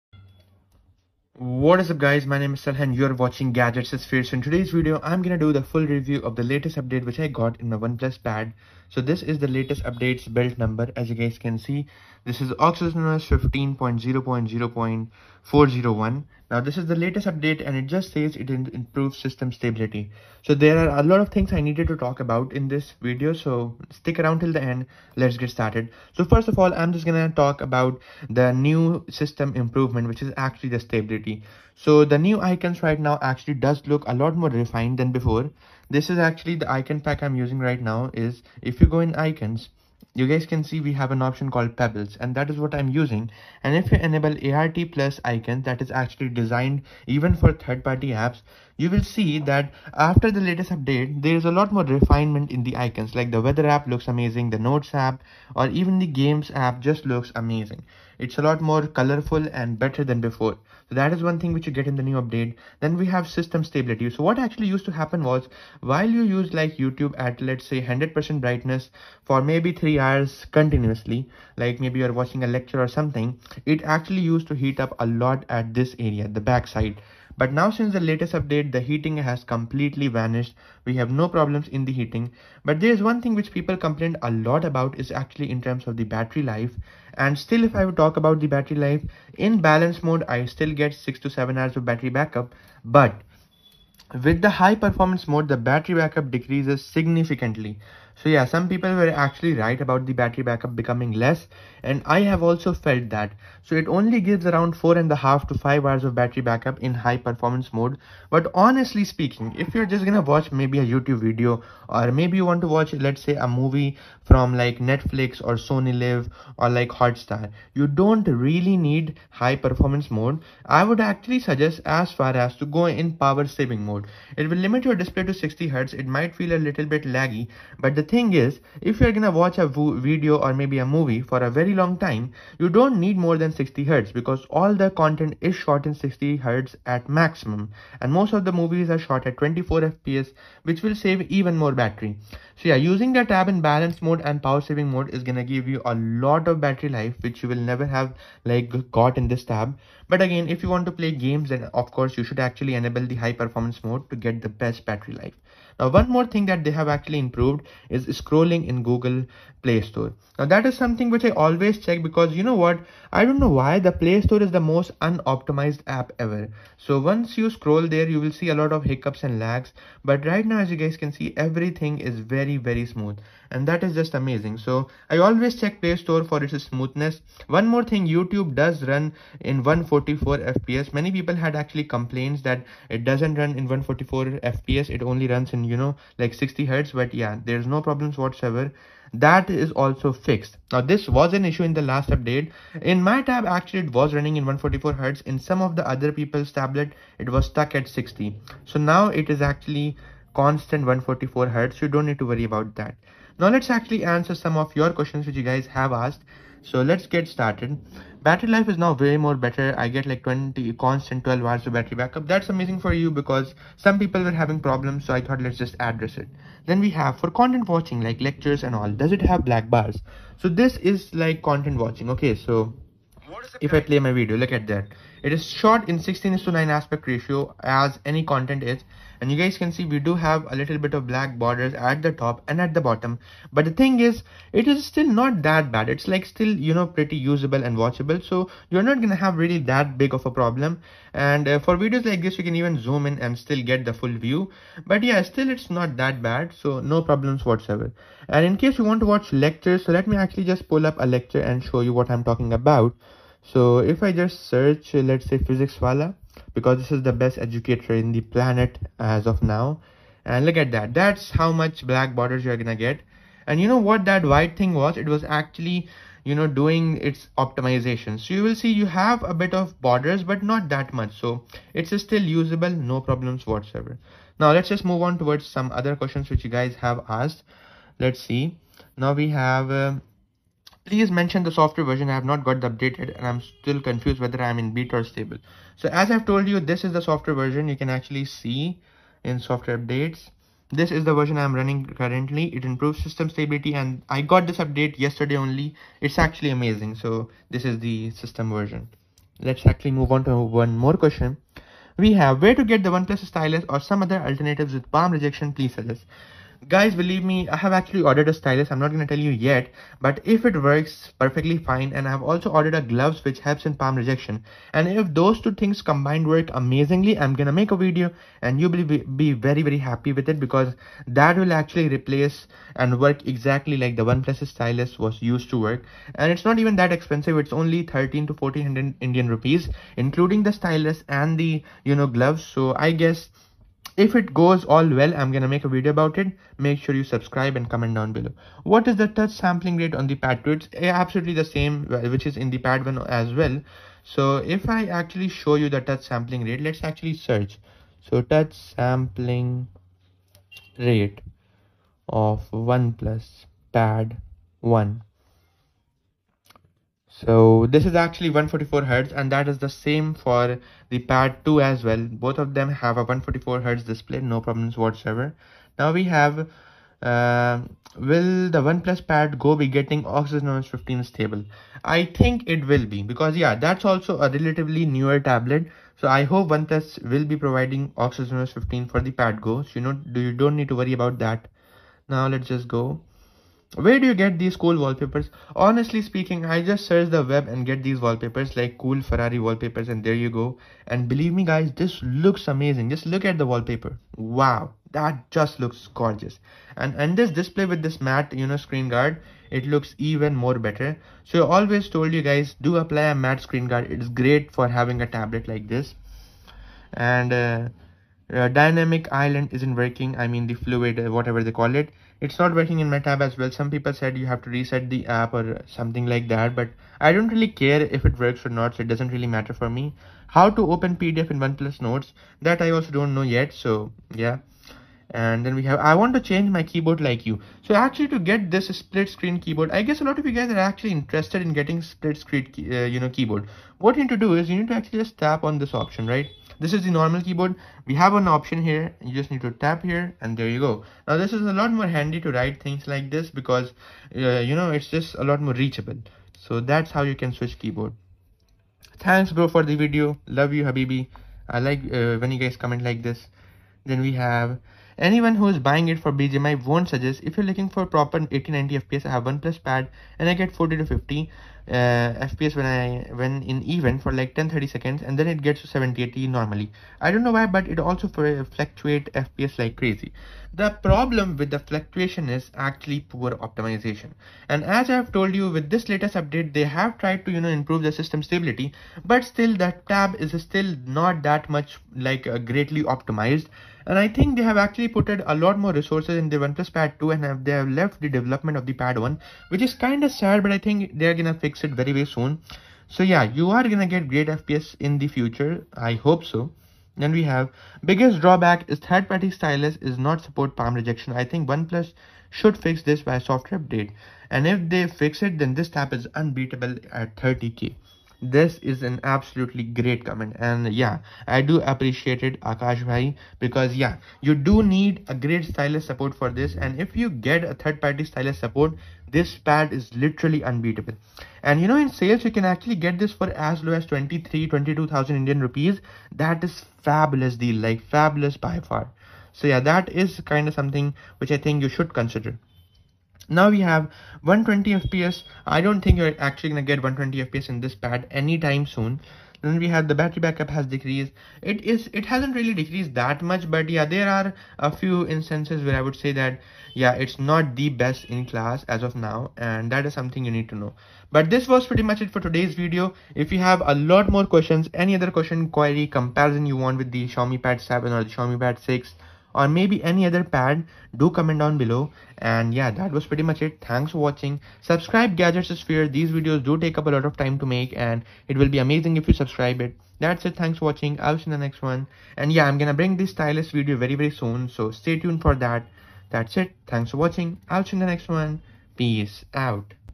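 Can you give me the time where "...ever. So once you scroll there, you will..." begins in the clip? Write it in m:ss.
2:46.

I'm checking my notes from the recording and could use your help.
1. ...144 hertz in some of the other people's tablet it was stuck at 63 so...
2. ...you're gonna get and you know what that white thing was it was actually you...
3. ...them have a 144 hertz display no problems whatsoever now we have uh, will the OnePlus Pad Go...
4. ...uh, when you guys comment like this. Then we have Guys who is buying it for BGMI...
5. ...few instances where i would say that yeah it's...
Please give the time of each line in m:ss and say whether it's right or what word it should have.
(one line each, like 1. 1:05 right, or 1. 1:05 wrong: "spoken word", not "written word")
1. 3:14 wrong: "60", not "63"
2. 4:22 right
3. 6:02 right
4. 7:31 wrong: "Anyone", not "Guys"
5. 9:04 right.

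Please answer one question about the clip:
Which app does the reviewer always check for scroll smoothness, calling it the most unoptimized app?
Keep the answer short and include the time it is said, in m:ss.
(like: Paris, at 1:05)
Google Play Store, at 2:38.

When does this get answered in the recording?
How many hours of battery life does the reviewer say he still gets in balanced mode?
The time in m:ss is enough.
1:30.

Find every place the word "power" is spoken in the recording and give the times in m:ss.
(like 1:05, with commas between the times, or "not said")
2:03, 2:24.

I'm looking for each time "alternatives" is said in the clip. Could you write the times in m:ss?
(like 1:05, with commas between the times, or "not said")
5:04.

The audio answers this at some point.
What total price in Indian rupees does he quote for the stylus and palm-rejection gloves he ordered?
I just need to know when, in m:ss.
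5:27.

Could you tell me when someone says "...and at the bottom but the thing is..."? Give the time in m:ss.
3:52.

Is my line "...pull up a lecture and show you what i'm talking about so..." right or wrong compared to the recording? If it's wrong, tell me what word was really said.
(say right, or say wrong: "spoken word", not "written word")
right.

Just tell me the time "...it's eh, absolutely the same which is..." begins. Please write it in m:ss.
5:40.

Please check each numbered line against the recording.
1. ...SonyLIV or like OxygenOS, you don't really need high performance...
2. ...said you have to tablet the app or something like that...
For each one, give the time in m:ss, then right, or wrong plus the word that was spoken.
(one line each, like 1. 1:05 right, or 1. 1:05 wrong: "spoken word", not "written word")
1. 1:55 wrong: "Hotstar", not "OxygenOS"
2. 6:53 wrong: "reset", not "tablet".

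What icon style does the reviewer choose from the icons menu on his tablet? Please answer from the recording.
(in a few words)
Pebbles.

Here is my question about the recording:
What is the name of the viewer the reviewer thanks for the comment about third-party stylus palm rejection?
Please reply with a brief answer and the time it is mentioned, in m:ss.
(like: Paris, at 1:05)
Akash, at 8:32.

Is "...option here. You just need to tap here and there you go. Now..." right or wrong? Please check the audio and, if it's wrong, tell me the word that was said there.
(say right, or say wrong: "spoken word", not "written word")
right.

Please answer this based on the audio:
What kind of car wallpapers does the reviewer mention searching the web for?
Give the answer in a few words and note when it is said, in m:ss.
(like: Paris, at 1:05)
Ferrari, at 6:29.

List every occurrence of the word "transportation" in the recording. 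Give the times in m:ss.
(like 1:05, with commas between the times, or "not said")
not said.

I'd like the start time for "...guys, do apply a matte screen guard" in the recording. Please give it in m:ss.
6:42.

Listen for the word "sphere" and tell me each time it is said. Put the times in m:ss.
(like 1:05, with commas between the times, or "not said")
0:03, 9:25.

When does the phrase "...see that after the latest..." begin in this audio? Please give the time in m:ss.
0:49.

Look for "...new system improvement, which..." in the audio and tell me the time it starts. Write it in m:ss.
0:28.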